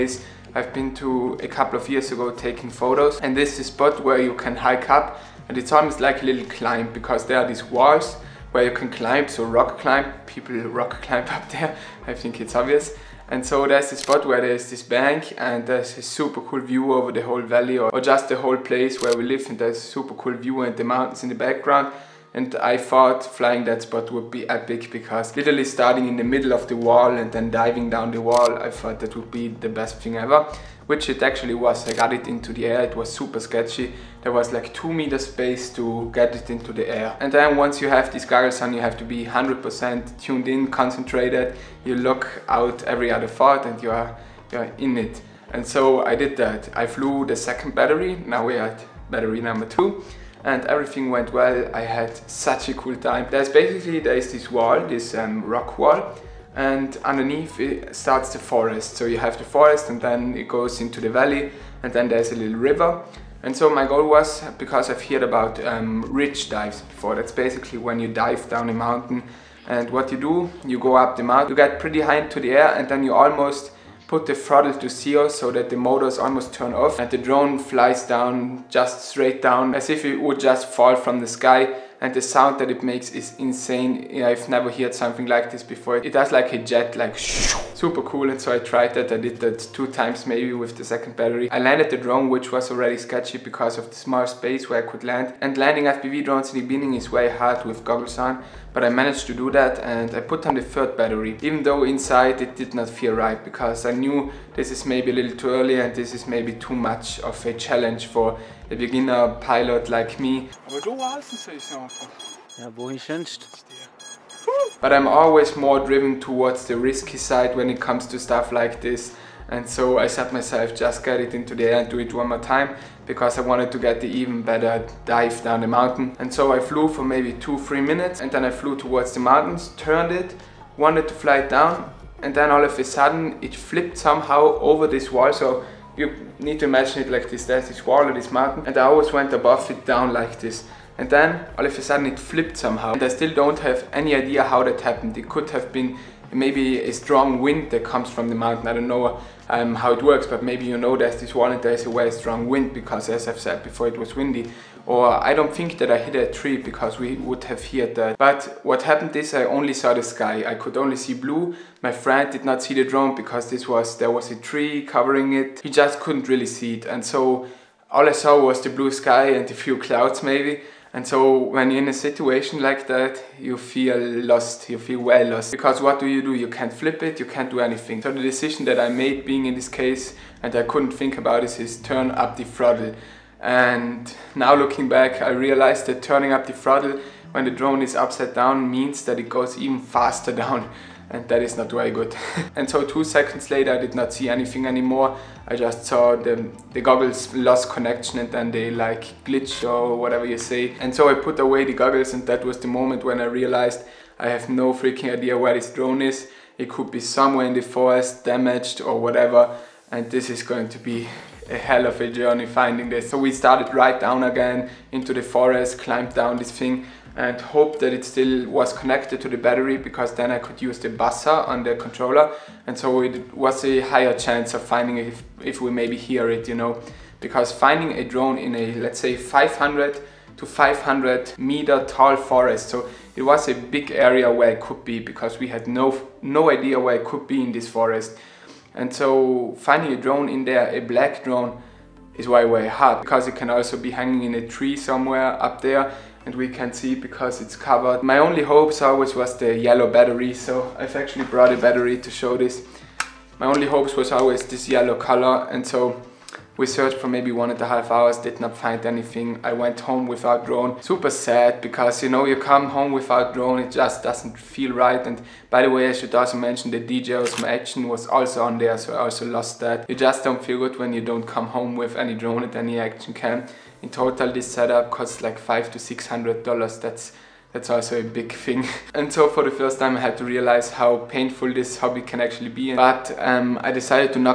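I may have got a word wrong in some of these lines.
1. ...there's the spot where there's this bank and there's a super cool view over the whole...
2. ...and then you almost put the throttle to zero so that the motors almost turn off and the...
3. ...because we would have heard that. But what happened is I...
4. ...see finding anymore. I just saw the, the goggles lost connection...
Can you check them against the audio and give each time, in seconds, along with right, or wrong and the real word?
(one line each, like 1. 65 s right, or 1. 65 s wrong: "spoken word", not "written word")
1. 13 s right
2. 72 s right
3. 156 s right
4. 194 s wrong: "anything", not "finding".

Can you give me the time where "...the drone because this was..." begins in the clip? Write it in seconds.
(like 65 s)
162 s.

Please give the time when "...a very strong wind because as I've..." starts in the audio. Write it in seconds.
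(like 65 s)
151 s.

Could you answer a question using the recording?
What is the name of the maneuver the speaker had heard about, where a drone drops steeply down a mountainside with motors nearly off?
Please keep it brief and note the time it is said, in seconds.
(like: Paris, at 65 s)
Ridge dives, at 66 s.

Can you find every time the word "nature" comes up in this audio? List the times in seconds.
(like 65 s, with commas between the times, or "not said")
not said.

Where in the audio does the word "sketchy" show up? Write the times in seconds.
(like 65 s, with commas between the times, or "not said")
33 s, 92 s.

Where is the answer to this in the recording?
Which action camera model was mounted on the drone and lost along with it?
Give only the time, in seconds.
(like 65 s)
266 s.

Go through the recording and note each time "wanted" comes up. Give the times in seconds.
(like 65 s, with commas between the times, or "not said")
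123 s, 130 s.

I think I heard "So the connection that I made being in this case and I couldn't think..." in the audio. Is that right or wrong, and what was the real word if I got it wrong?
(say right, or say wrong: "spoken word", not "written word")
wrong: "decision", not "connection".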